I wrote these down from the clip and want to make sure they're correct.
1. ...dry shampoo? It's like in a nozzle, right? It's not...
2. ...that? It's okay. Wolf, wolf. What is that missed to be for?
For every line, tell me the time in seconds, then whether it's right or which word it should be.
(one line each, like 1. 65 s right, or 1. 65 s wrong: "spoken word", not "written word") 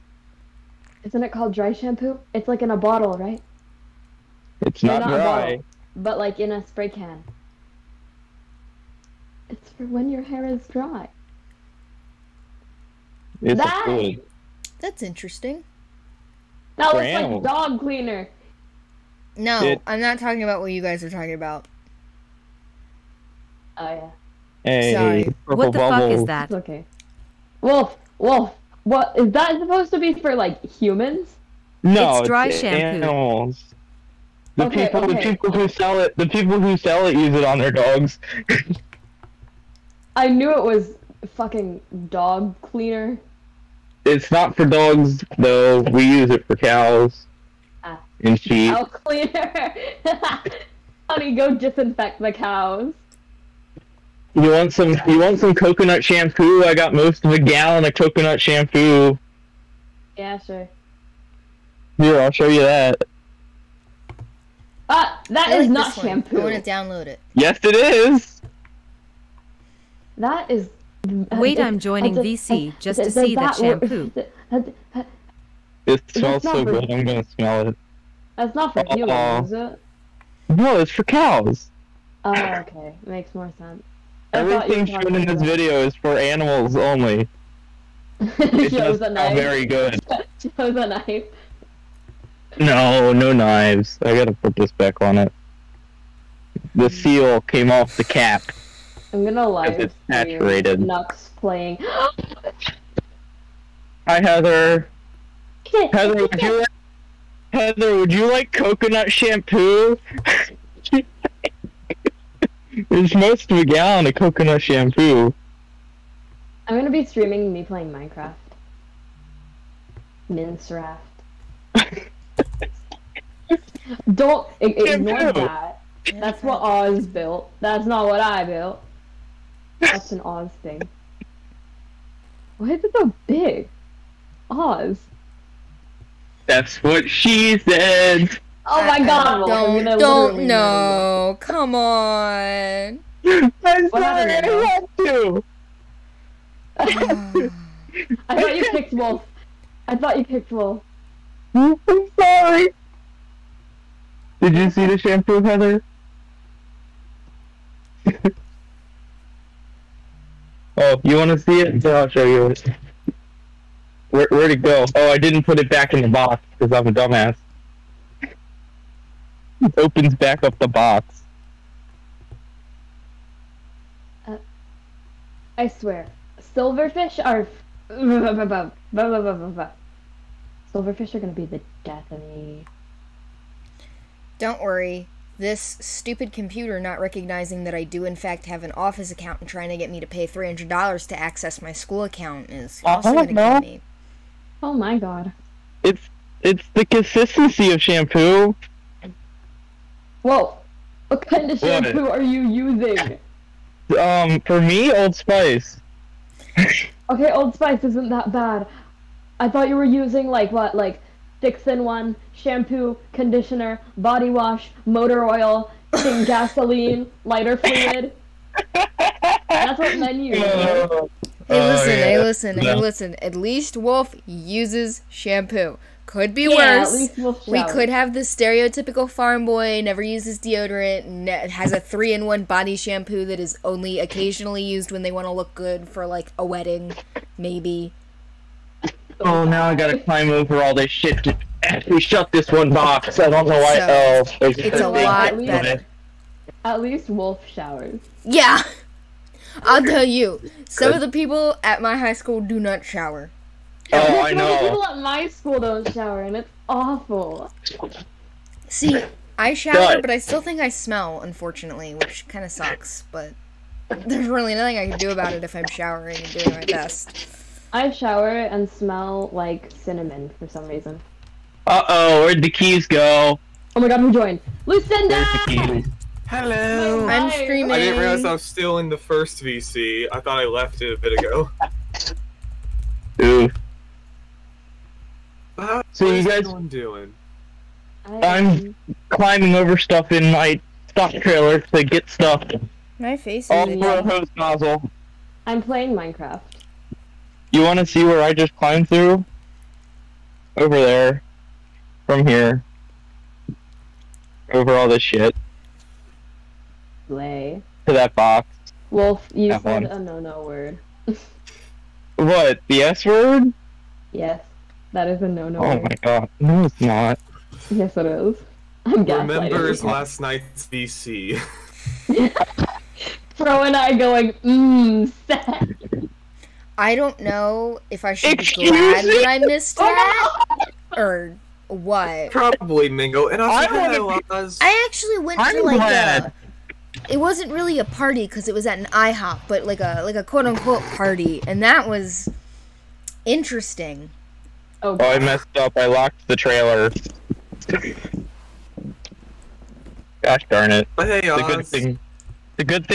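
1. 1 s wrong: "bottle", not "nozzle"
2. 26 s wrong: "supposed", not "missed".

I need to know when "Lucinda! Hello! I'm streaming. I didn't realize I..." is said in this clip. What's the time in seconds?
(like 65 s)
274 s.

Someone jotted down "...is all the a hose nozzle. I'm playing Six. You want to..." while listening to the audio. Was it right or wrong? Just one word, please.
wrong.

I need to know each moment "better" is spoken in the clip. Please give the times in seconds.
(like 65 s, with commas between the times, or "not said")
245 s.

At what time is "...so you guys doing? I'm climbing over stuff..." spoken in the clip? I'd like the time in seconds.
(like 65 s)
285 s.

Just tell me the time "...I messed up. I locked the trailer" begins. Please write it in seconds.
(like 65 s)
345 s.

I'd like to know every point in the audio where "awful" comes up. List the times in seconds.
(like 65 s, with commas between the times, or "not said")
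256 s.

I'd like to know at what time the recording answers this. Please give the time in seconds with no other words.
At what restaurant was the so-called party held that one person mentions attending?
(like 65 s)
338 s.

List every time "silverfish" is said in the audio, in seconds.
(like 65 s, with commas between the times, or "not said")
176 s, 180 s.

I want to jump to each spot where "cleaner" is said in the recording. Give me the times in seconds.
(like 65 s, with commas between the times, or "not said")
17 s, 42 s, 48 s.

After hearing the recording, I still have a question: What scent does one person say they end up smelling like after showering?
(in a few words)
Cinnamon.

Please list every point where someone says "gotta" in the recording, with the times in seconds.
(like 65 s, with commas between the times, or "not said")
94 s, 239 s.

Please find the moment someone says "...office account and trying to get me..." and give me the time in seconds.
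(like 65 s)
188 s.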